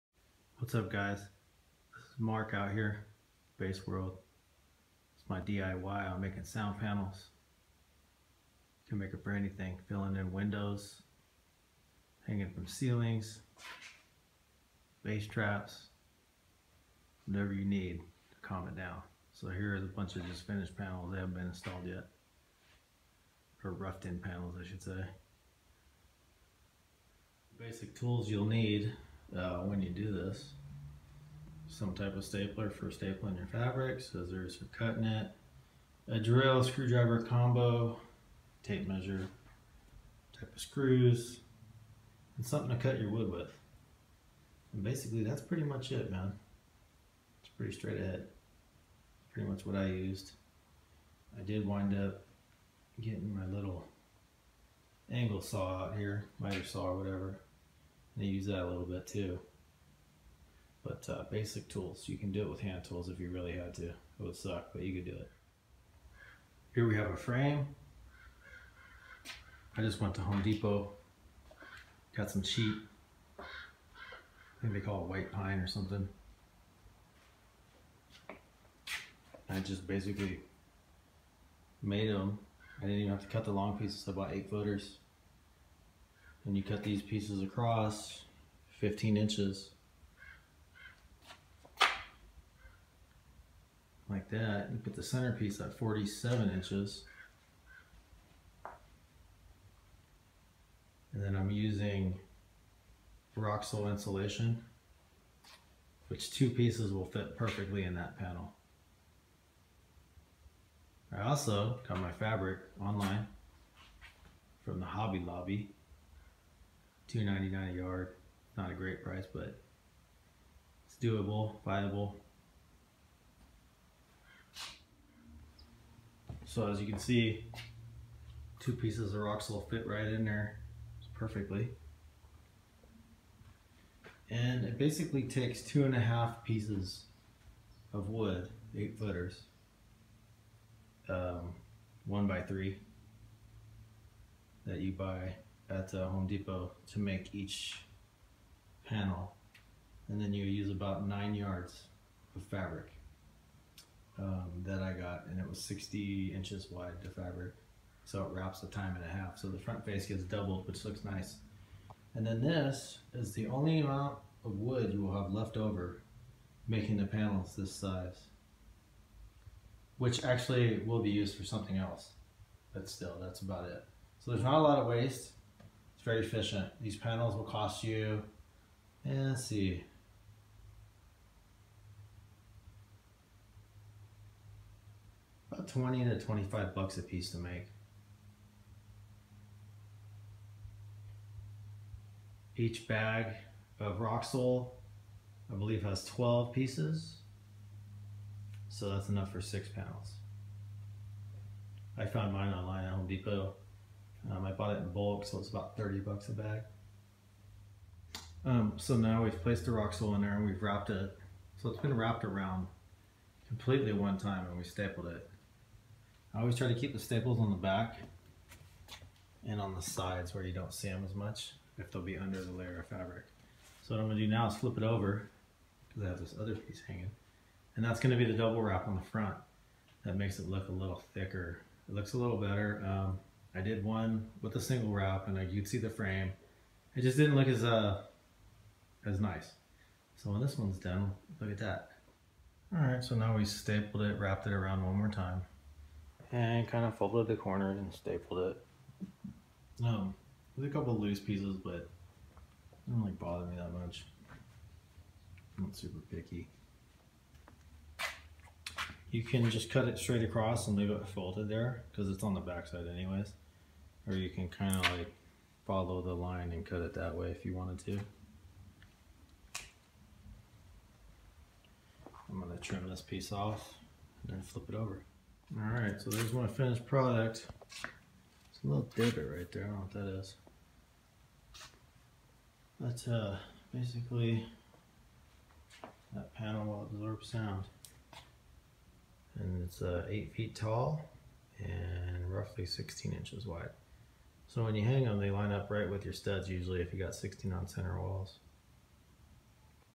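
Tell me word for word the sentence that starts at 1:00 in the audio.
But uh, basic tools, you can do it with hand tools if you really had to.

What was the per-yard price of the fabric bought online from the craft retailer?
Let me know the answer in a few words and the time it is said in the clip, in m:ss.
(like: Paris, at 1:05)
$2.99, at 1:57.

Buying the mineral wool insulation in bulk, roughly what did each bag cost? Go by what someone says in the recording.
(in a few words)
$30.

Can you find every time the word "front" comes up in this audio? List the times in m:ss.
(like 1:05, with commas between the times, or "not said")
2:39, 3:49.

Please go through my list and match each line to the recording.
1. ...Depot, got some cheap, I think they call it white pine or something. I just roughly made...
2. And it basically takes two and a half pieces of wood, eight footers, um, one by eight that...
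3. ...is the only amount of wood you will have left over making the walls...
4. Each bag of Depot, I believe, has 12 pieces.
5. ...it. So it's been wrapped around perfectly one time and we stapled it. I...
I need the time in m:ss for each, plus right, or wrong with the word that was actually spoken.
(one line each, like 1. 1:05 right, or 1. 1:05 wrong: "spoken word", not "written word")
1. 1:10 wrong: "basically", not "roughly"
2. 2:14 wrong: "three", not "eight"
3. 2:43 wrong: "panels", not "walls"
4. 3:12 wrong: "Roxul", not "Depot"
5. 3:30 wrong: "completely", not "perfectly".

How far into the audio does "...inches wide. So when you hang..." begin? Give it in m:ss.
4:53.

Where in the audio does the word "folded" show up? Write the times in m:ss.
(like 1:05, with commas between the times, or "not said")
4:06, 4:21.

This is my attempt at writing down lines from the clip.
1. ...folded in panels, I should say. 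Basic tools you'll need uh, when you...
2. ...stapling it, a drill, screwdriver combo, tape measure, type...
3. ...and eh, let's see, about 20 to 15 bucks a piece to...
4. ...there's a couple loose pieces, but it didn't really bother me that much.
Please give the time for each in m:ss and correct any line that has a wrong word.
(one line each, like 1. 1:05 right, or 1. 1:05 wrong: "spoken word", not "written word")
1. 0:23 wrong: "roughed", not "folded"
2. 0:34 wrong: "cutting", not "stapling"
3. 2:59 wrong: "25", not "15"
4. 4:10 right.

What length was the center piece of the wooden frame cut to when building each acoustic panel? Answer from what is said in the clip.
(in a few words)
47 inches.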